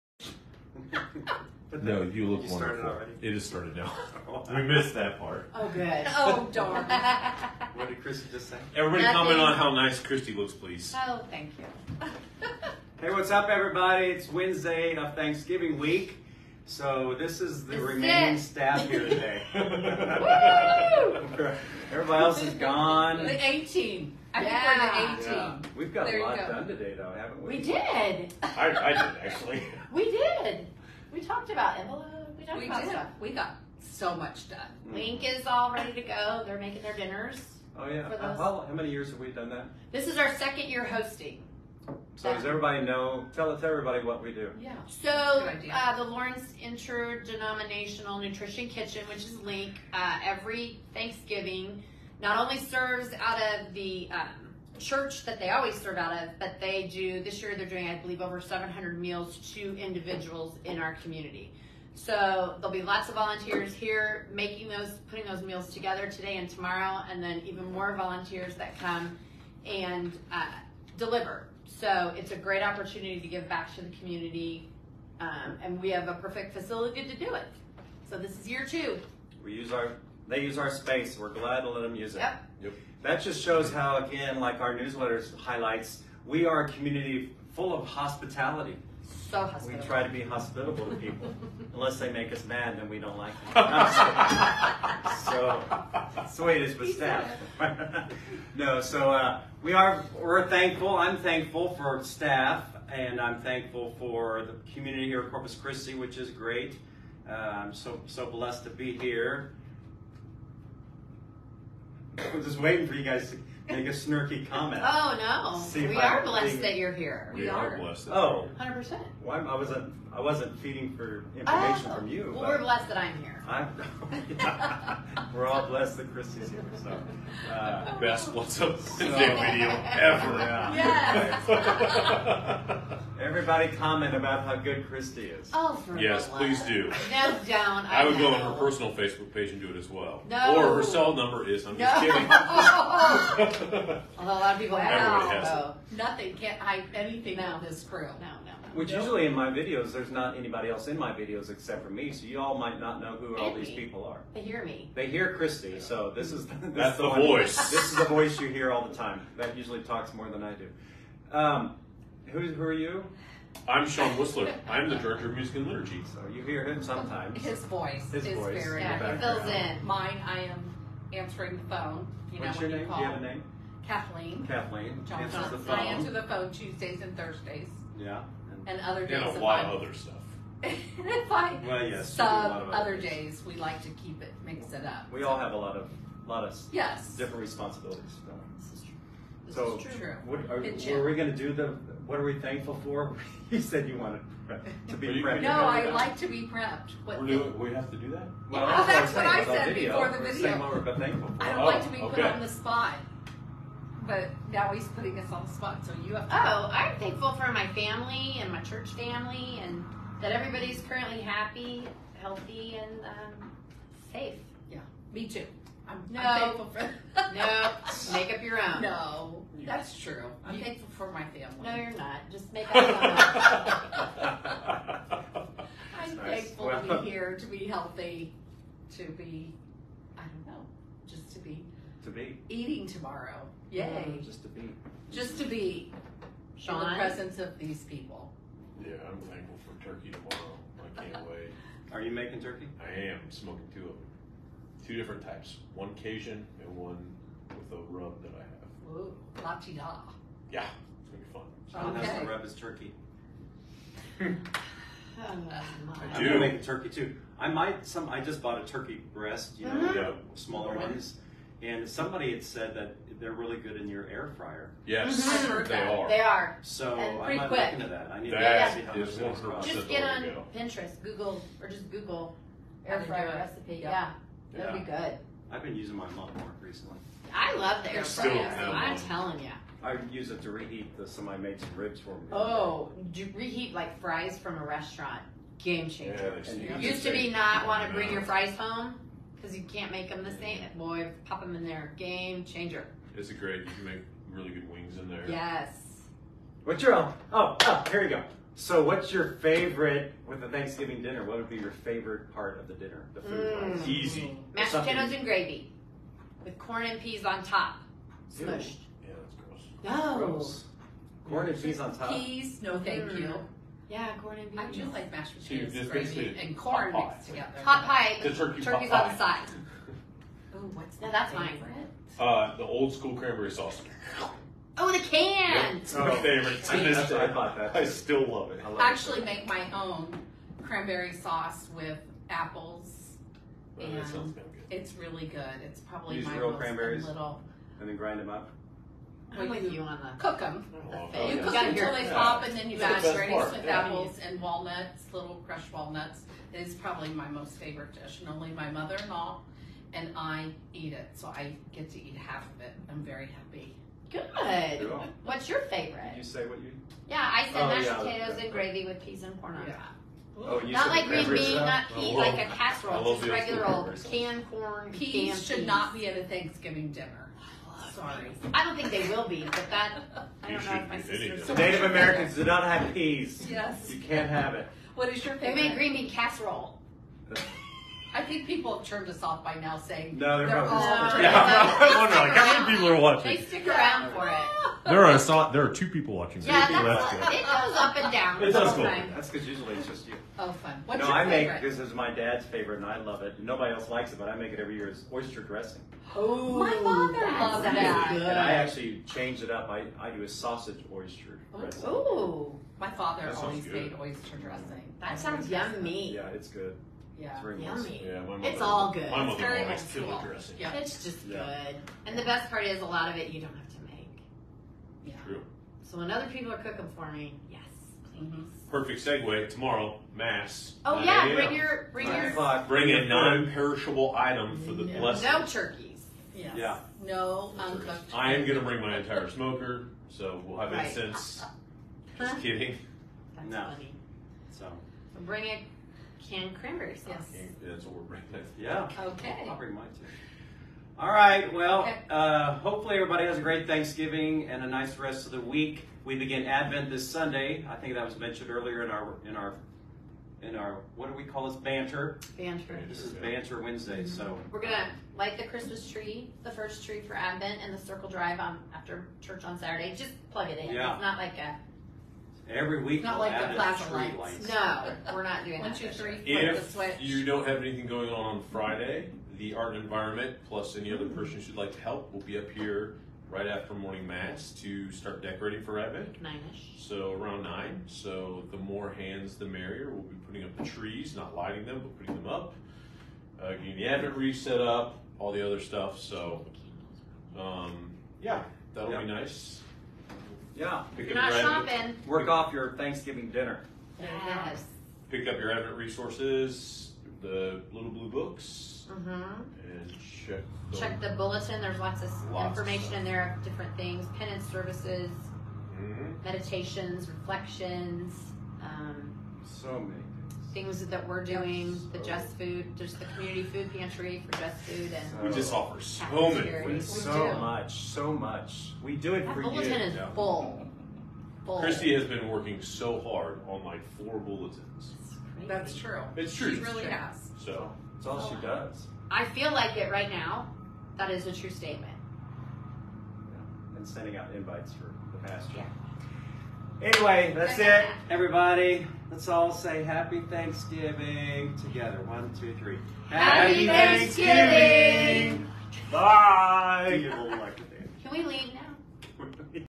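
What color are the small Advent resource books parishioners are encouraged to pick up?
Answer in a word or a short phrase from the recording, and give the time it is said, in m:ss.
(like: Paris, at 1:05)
blue, at 8:17.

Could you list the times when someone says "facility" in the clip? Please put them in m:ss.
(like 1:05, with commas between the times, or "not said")
1:16.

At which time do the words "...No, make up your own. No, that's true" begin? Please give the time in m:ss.
3:37.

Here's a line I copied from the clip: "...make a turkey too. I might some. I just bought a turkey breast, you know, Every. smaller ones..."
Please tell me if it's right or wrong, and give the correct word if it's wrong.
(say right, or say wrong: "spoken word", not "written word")
wrong: "Mhm", not "Every".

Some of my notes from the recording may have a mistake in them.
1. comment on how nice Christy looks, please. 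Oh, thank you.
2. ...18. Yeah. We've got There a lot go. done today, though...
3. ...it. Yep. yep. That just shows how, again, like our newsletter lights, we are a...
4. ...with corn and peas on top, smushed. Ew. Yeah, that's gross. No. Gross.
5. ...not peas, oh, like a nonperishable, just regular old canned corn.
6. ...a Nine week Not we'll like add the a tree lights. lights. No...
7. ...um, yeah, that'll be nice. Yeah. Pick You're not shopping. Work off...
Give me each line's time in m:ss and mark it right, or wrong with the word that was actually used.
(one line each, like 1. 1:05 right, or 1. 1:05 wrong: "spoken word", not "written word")
1. 0:09 right
2. 0:25 right
3. 1:22 wrong: "highlights", not "lights"
4. 5:06 right
5. 6:01 wrong: "casserole", not "nonperishable"
6. 7:41 wrong: "Every", not "Nine"
7. 8:07 right.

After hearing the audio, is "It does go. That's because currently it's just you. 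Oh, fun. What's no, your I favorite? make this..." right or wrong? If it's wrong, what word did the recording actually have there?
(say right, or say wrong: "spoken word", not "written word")
wrong: "usually", not "currently".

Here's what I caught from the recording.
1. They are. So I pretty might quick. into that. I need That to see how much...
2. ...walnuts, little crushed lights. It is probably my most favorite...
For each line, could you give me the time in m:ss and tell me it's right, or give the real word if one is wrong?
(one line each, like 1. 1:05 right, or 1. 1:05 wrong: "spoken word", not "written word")
1. 4:26 right
2. 5:44 wrong: "walnuts", not "lights".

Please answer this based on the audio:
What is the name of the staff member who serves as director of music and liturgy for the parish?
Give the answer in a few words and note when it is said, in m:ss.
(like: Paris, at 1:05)
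Sean Whistler, at 2:43.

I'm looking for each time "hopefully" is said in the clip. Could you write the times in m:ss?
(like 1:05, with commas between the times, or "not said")
7:22.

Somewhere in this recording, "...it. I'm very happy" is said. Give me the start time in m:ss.
5:52.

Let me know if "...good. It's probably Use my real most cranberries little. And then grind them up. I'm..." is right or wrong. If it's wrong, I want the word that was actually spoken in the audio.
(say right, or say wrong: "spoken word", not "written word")
right.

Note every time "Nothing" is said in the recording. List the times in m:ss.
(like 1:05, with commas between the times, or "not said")
0:09, 2:25.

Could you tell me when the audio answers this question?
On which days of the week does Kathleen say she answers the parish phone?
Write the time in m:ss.
2:56.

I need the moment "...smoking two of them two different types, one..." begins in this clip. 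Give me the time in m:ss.
4:03.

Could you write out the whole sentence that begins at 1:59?
why I wasn't I wasn't feeding for information oh.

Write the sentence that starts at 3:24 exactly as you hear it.
But now he's putting us on the spot, so you have to.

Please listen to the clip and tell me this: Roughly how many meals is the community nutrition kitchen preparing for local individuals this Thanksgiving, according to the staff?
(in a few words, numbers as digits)
over 700.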